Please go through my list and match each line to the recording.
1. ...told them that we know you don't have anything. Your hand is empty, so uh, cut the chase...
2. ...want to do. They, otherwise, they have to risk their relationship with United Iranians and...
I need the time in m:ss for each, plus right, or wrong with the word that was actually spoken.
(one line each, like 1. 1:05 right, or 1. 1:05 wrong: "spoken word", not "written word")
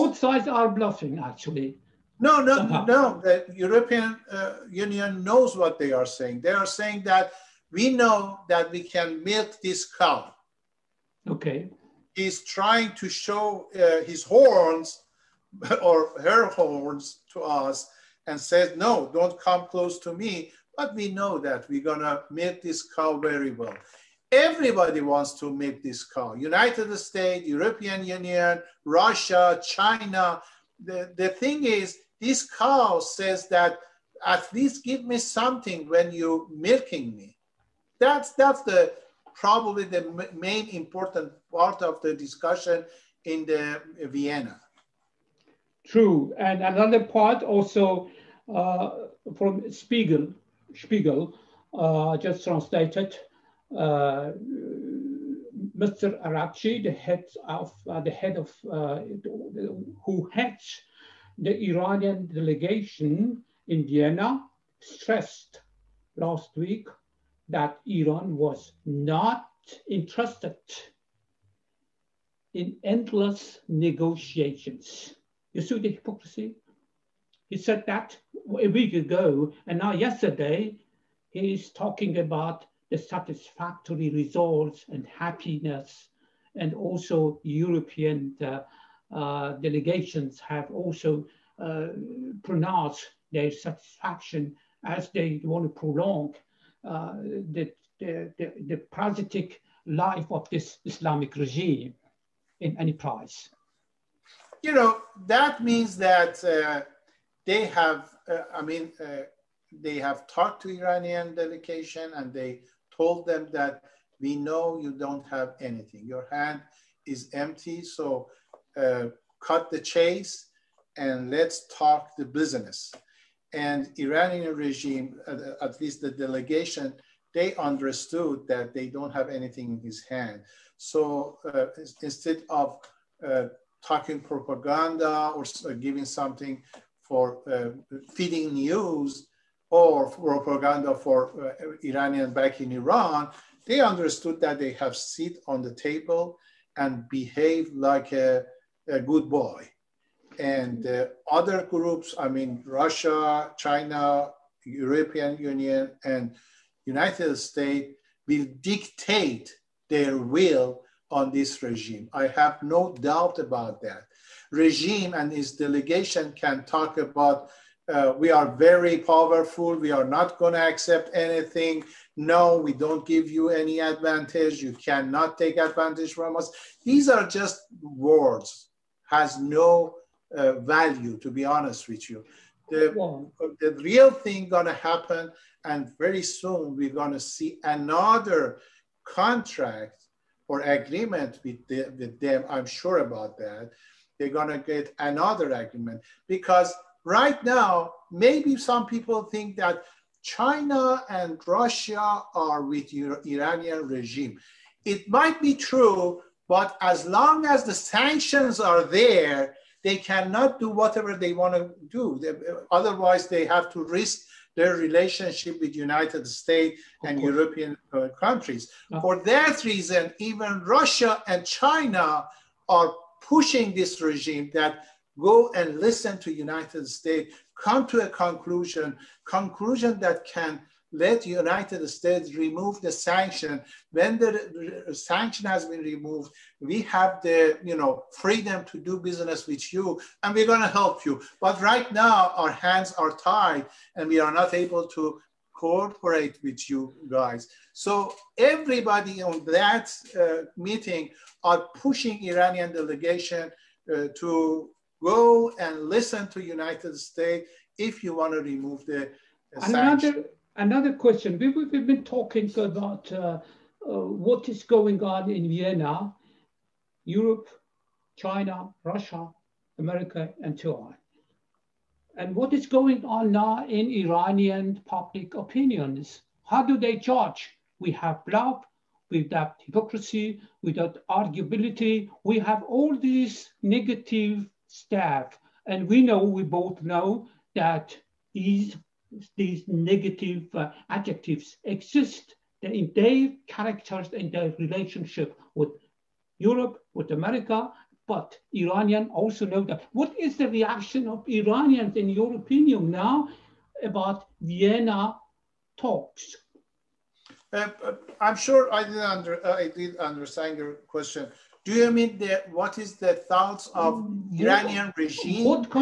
1. 1:52 right
2. 3:31 wrong: "States", not "Iranians".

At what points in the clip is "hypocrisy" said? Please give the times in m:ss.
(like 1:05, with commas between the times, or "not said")
1:15, 4:39.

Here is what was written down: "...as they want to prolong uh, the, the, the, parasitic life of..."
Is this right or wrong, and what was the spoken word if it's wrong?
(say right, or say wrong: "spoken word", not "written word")
right.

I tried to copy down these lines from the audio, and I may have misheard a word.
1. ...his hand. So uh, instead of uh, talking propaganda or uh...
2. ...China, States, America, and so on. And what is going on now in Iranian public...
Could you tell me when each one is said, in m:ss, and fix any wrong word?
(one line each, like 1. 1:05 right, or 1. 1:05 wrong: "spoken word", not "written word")
1. 2:09 right
2. 4:28 wrong: "Russia", not "States".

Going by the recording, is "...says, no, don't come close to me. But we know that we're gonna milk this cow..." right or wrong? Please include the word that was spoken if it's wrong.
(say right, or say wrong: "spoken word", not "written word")
right.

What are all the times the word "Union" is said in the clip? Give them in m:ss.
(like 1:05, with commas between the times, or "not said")
0:04, 0:28, 2:35.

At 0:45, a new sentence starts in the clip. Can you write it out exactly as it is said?
True, and another part also uh, from Spiegel, Spiegel, uh, just translated, uh, Mr.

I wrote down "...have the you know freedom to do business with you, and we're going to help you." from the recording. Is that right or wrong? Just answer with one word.
right.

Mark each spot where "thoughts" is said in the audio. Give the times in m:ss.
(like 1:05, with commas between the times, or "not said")
5:13.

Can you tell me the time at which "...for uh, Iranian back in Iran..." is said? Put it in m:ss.
2:20.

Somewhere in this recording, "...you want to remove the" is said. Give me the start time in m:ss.
4:18.